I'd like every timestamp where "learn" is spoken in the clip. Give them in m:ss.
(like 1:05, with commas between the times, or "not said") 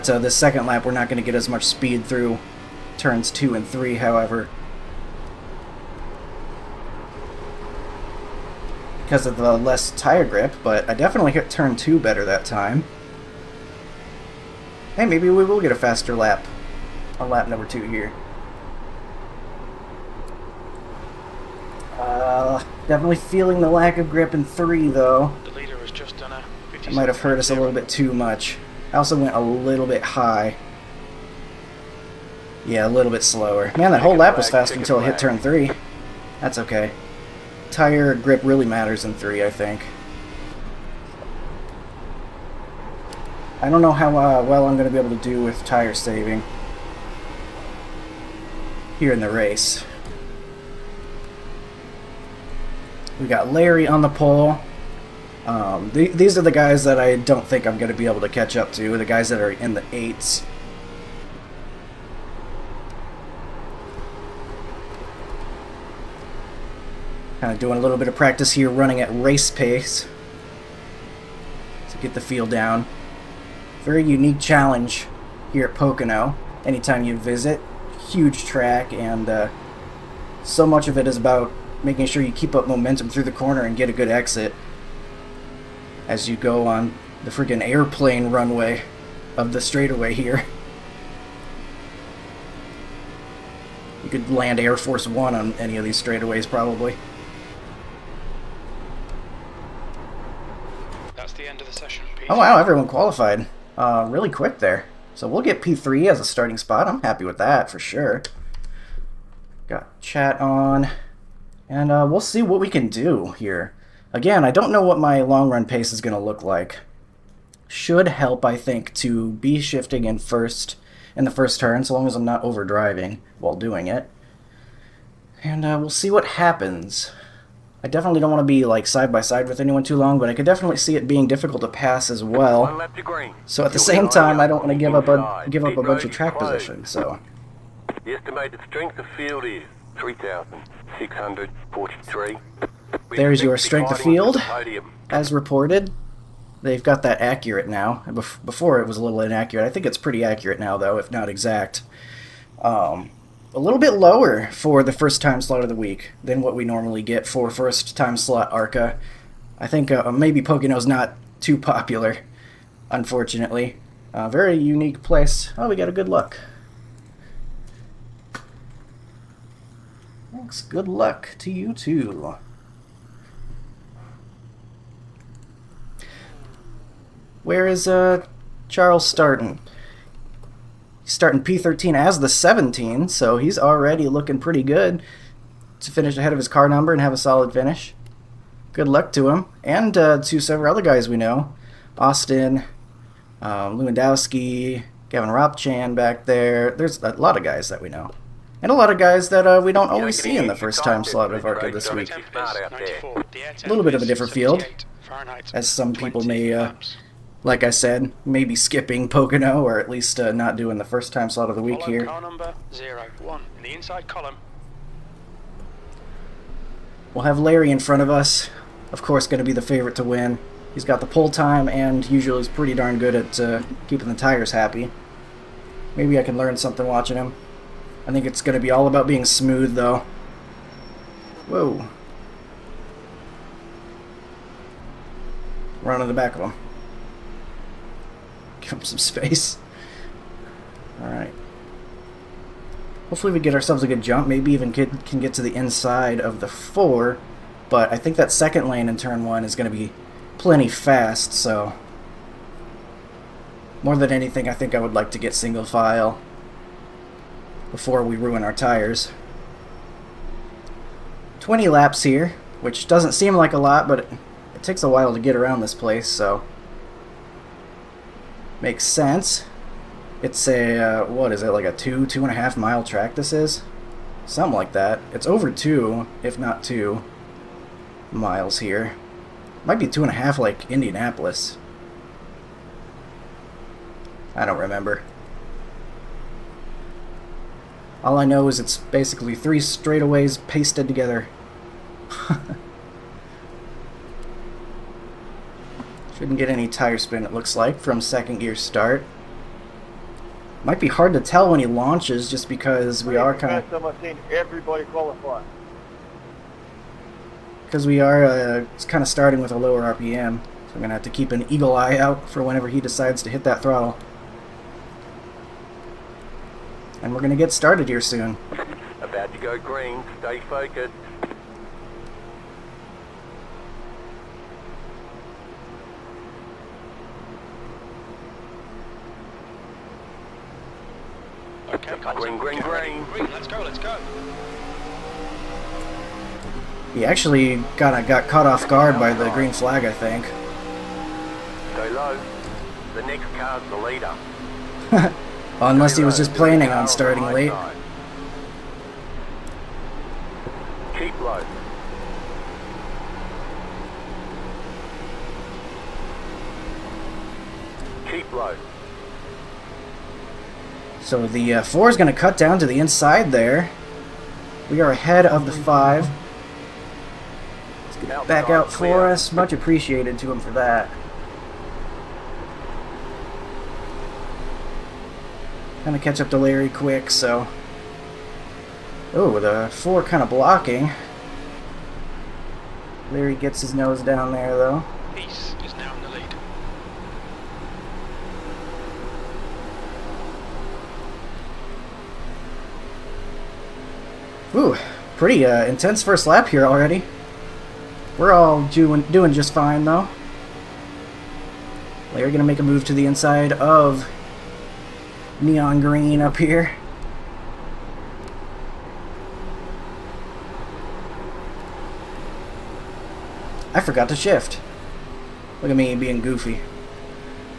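3:46.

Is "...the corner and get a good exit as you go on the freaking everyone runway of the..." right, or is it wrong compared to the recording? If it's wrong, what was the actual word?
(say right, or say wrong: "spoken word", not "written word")
wrong: "airplane", not "everyone".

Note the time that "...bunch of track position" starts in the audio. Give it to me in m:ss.
2:15.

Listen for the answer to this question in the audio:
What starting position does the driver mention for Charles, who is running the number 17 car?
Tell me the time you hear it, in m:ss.
3:01.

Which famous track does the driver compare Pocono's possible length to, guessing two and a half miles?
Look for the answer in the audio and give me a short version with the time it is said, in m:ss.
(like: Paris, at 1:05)
Indianapolis, at 4:40.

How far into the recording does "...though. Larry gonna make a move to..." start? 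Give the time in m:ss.
6:39.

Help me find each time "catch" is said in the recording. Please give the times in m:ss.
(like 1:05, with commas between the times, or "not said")
0:58, 6:16.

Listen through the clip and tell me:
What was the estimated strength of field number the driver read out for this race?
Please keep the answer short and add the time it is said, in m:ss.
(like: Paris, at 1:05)
3,643, at 2:19.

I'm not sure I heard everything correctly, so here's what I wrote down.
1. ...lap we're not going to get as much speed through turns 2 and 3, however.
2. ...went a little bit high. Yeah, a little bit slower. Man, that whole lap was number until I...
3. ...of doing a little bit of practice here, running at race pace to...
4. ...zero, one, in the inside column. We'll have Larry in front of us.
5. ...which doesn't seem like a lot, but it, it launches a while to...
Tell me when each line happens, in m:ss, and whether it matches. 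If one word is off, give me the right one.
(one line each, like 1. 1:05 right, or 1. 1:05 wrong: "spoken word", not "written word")
1. 0:00 right
2. 0:29 wrong: "faster", not "number"
3. 1:07 right
4. 3:32 right
5. 4:22 wrong: "takes", not "launches".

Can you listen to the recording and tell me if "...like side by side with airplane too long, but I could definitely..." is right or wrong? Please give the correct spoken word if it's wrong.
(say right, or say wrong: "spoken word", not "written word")
wrong: "anyone", not "airplane".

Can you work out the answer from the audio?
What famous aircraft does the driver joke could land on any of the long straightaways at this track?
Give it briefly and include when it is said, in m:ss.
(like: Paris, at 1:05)
Air Force One, at 1:34.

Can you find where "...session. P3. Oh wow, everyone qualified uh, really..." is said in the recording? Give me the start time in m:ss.
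1:41.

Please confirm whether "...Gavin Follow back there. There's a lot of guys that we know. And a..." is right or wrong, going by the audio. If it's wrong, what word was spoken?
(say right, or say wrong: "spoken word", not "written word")
wrong: "Ropchan", not "Follow".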